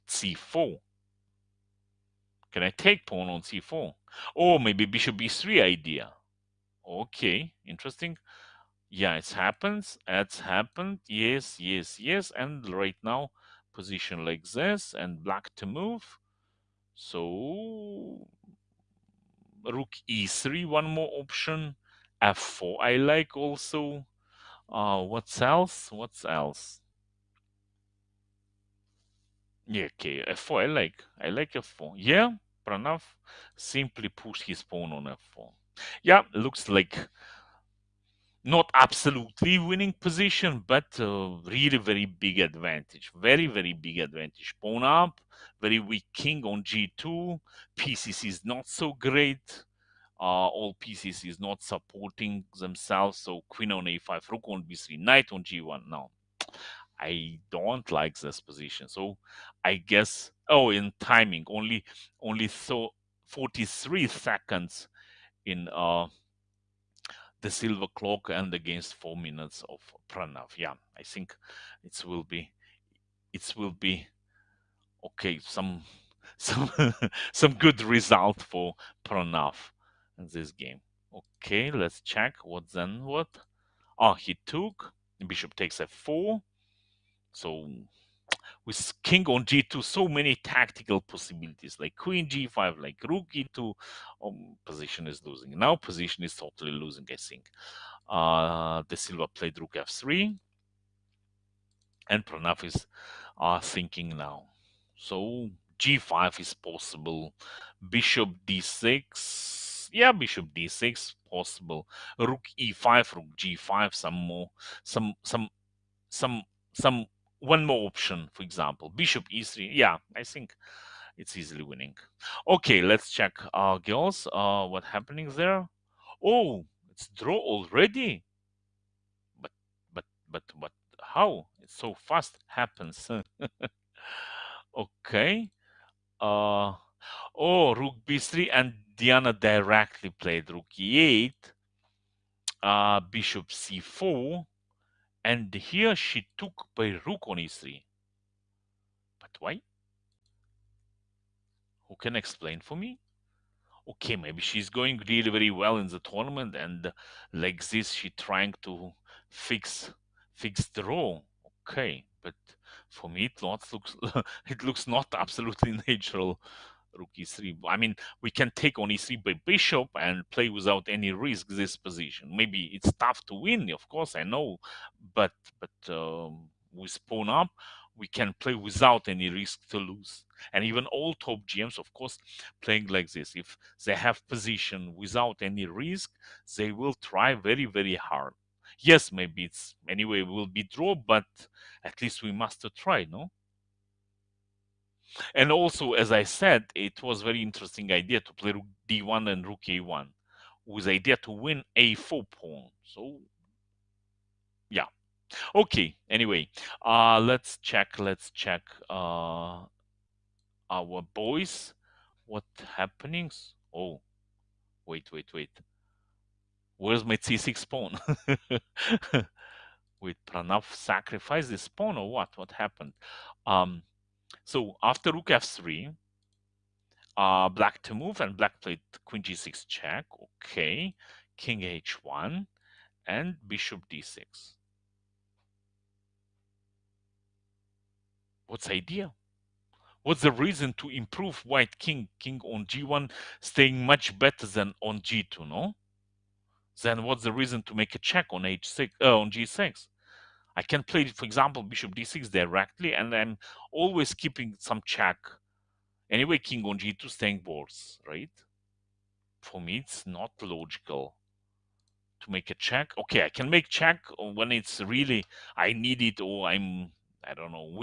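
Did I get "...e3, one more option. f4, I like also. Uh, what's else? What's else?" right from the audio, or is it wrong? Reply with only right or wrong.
right.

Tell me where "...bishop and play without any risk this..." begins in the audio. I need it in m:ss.
2:49.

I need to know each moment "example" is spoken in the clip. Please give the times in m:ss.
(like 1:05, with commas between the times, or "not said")
1:58, 4:11.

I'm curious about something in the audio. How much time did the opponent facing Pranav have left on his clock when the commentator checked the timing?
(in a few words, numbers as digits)
43 seconds.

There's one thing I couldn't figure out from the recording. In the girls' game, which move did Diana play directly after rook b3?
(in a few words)
rook e8.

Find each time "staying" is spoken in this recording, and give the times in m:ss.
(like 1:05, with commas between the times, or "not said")
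4:03, 4:17.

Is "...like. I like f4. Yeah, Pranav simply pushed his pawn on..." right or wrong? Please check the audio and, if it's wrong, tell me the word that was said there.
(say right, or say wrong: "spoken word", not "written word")
right.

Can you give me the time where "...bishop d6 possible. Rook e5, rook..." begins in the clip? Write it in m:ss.
1:50.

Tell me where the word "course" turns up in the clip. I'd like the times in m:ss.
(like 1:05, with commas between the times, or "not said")
2:53, 3:01.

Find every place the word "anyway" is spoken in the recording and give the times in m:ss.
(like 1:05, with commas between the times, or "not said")
3:09, 3:26, 4:16.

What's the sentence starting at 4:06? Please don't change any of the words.
Then what's the reason to make a check on h6, uh, on g6?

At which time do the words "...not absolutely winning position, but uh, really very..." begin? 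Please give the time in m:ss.
0:38.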